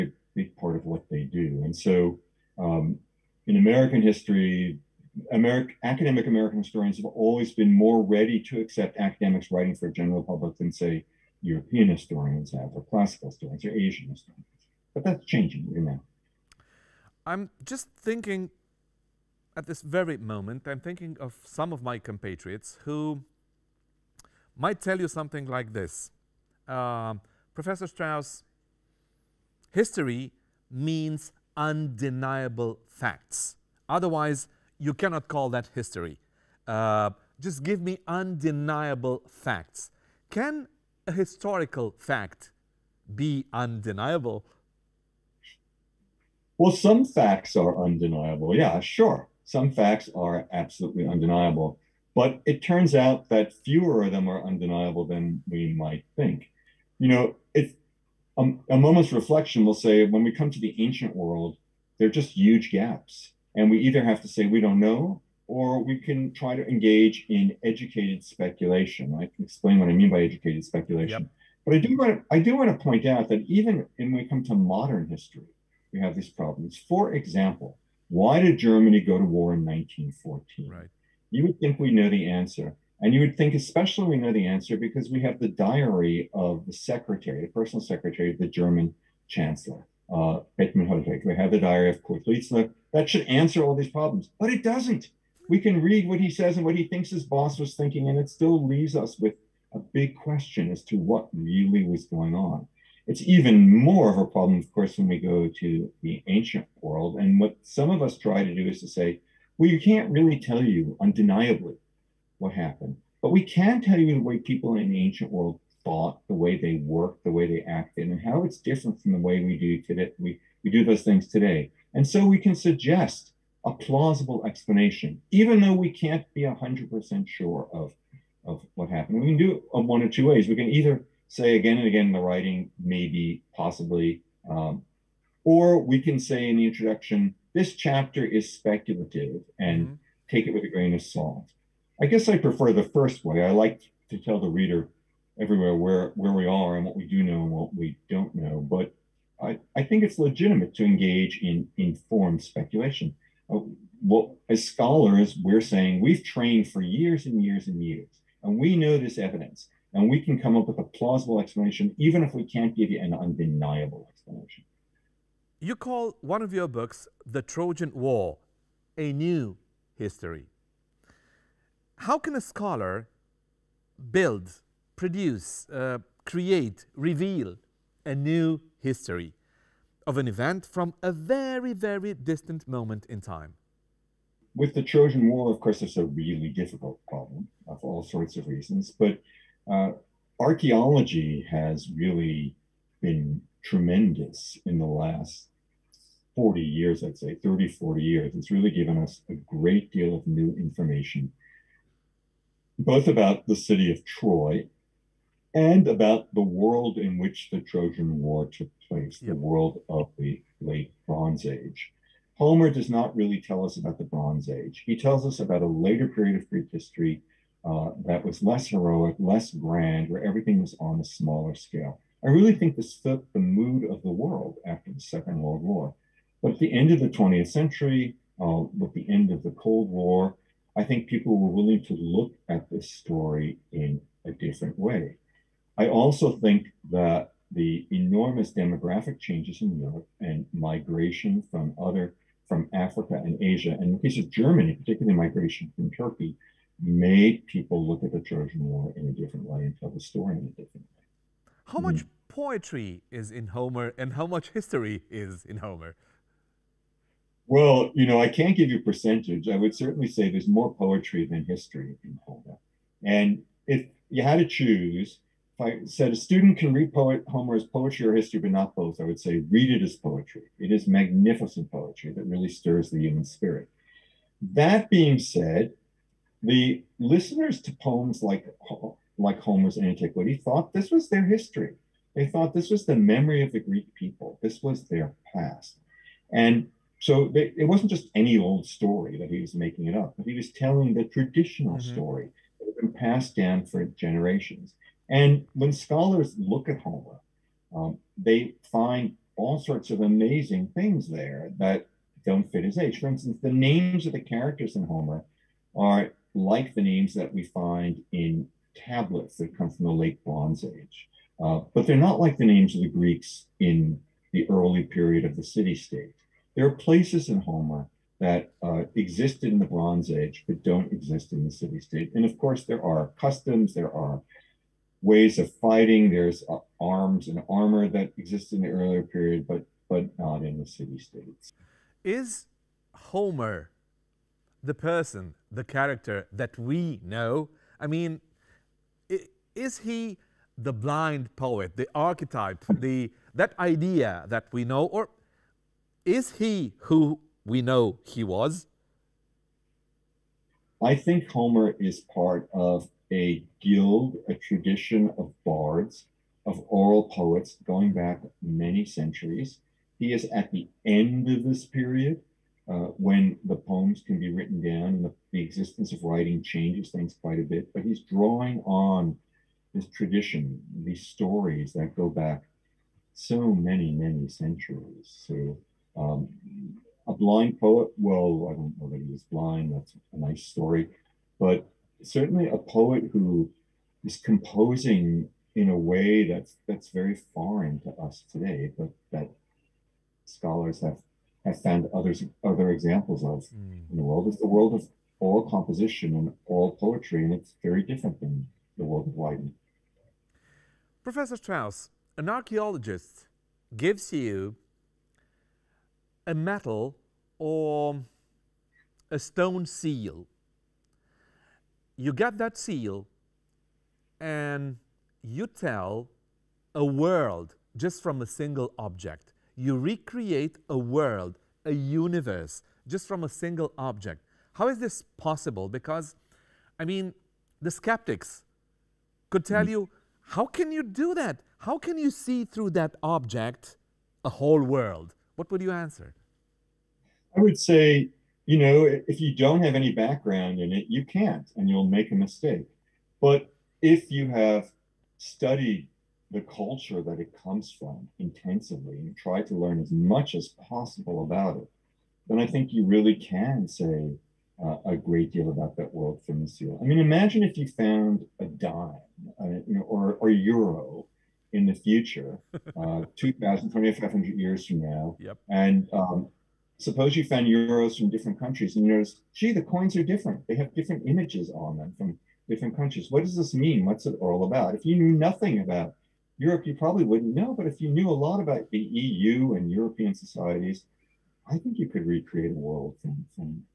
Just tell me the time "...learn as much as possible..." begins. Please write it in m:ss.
7:29.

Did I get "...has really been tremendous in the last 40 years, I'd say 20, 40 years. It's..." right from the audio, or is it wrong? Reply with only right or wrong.
wrong.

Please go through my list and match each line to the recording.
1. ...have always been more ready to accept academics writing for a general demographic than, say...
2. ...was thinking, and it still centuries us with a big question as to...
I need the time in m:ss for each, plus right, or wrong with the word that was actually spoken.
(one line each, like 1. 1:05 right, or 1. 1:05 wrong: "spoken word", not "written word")
1. 0:06 wrong: "public", not "demographic"
2. 1:37 wrong: "leaves", not "centuries".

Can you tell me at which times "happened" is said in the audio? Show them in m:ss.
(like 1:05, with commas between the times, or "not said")
1:52, 2:08.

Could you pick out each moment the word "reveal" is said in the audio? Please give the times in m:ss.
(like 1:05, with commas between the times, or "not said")
2:56.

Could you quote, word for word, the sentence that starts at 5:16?
There are places in Homer that uh, existed in the Bronze Age but don't exist in the city state.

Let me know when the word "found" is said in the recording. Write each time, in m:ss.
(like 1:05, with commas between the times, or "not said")
6:31, 7:37, 7:47.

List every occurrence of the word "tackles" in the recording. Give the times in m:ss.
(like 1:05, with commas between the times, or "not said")
not said.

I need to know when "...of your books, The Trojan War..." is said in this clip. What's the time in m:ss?
2:46.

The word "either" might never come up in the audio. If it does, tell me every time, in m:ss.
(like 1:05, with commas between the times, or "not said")
1:03, 2:10.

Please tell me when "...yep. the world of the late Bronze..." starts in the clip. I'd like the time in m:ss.
3:29.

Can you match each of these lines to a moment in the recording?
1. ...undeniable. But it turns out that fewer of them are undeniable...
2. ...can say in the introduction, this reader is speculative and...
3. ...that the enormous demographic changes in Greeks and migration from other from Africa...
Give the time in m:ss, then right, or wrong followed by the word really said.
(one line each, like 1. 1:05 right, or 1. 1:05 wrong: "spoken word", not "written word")
1. 0:51 right
2. 2:16 wrong: "chapter", not "reader"
3. 3:56 wrong: "Europe", not "Greeks".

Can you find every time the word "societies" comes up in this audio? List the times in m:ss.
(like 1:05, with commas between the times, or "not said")
8:00.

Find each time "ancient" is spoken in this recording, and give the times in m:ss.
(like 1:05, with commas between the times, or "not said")
1:00, 1:46, 1:55.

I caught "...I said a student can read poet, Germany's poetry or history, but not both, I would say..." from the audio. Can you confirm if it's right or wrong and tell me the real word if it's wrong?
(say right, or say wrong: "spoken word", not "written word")
wrong: "Homer", not "Germany".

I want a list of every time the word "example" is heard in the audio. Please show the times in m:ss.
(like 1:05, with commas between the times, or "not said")
1:17, 6:32.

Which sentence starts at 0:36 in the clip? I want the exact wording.
Uh, just give me undeniable facts.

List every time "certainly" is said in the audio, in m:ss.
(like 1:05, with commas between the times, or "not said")
4:19, 6:22.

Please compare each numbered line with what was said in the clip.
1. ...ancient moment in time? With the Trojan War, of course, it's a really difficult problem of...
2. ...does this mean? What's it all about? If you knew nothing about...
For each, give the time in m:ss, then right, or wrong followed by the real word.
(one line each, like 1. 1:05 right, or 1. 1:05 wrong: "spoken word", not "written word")
1. 3:02 wrong: "distant", not "ancient"
2. 7:53 right.